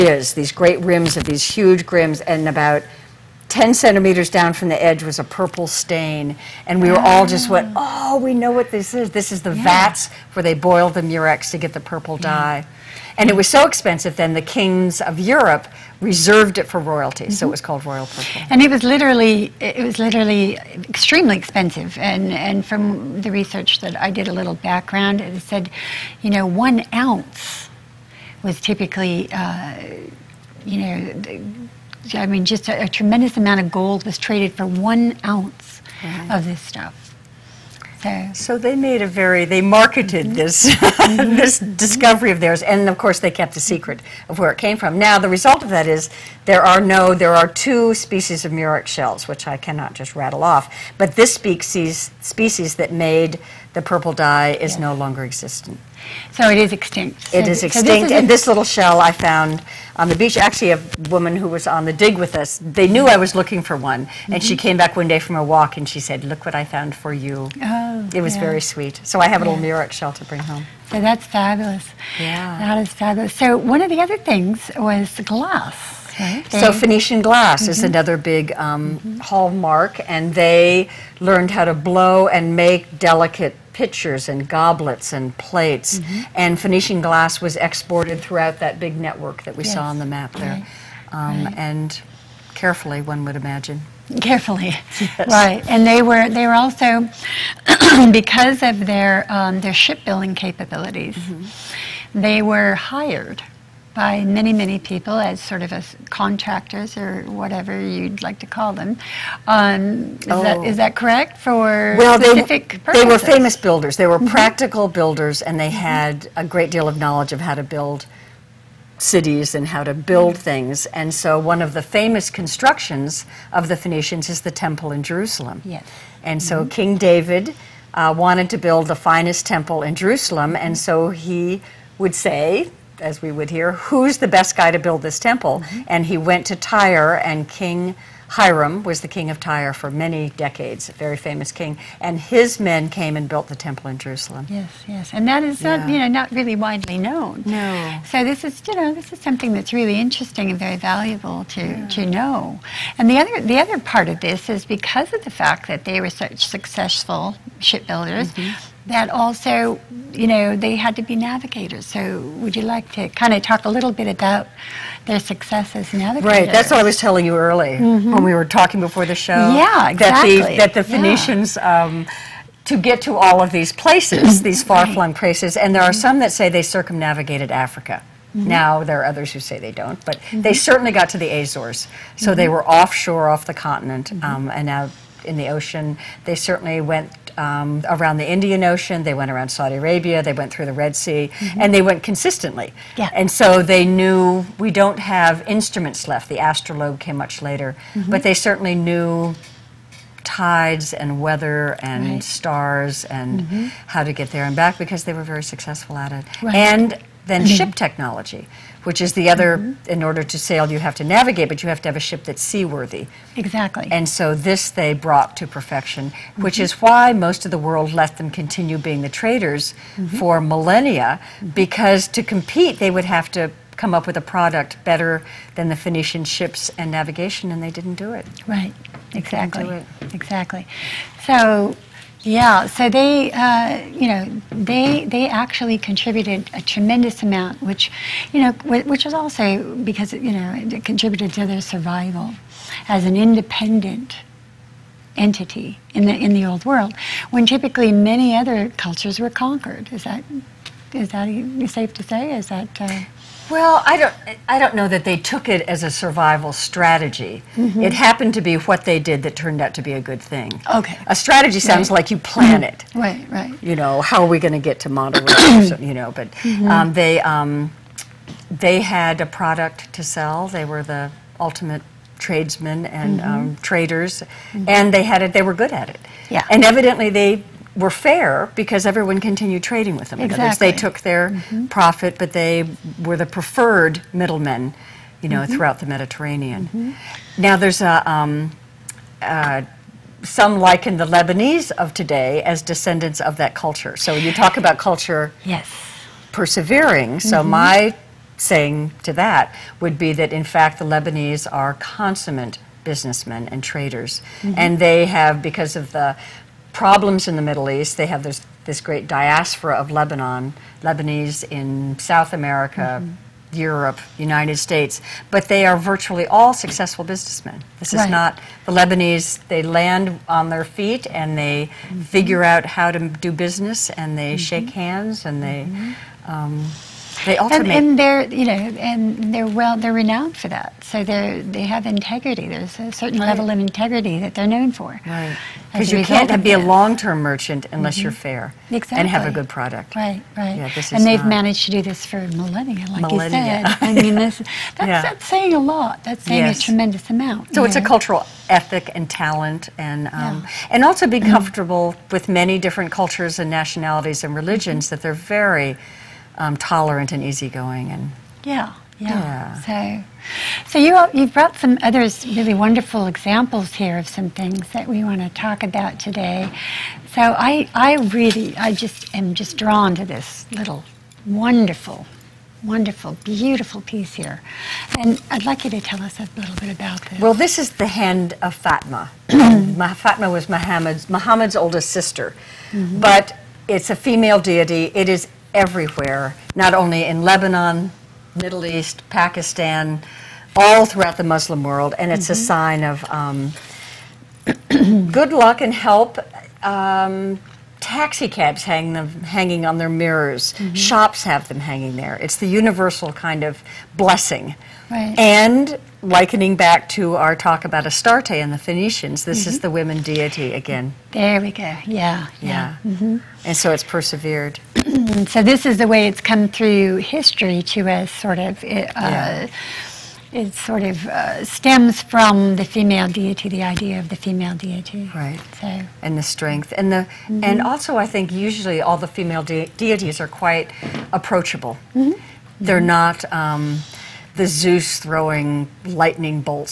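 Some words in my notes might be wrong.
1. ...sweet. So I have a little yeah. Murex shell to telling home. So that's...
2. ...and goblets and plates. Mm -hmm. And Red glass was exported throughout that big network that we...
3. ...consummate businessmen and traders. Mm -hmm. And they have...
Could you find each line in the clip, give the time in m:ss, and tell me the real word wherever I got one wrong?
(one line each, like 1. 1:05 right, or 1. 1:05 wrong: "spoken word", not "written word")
1. 1:08 wrong: "bring", not "telling"
2. 1:24 wrong: "Phoenician", not "Red"
3. 5:01 right.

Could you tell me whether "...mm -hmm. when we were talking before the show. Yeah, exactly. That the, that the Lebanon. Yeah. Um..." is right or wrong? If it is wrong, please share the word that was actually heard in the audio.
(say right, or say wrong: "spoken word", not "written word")
wrong: "Phoenicians", not "Lebanon".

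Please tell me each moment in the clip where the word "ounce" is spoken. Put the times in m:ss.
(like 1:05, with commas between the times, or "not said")
0:27, 0:35.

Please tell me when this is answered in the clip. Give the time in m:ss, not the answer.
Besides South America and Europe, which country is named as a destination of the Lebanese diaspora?
5:14.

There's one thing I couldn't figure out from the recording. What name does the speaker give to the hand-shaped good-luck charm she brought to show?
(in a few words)
hand of Fatma.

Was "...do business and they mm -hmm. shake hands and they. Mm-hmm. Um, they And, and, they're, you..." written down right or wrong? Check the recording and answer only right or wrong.
right.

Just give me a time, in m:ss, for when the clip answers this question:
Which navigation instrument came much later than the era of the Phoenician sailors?
3:16.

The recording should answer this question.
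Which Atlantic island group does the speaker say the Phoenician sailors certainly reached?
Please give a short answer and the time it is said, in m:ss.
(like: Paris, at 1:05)
Azores, at 3:01.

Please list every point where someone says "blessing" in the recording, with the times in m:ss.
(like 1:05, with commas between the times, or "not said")
6:43.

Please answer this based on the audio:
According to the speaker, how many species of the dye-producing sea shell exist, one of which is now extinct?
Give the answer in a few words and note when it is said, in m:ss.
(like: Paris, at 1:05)
2, at 0:47.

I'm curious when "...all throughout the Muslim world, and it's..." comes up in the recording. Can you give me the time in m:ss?
6:30.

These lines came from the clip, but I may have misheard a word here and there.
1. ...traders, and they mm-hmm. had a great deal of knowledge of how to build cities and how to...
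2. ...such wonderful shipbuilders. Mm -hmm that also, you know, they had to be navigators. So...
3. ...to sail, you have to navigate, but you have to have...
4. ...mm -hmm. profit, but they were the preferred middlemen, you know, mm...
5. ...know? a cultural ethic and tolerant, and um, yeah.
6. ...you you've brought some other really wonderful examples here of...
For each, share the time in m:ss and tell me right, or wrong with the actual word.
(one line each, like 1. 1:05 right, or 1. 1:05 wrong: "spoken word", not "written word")
1. 1:54 wrong: "builders", not "traders"
2. 2:36 wrong: "successful", not "wonderful"
3. 3:30 right
4. 4:41 right
5. 5:47 wrong: "talent", not "tolerant"
6. 6:00 right.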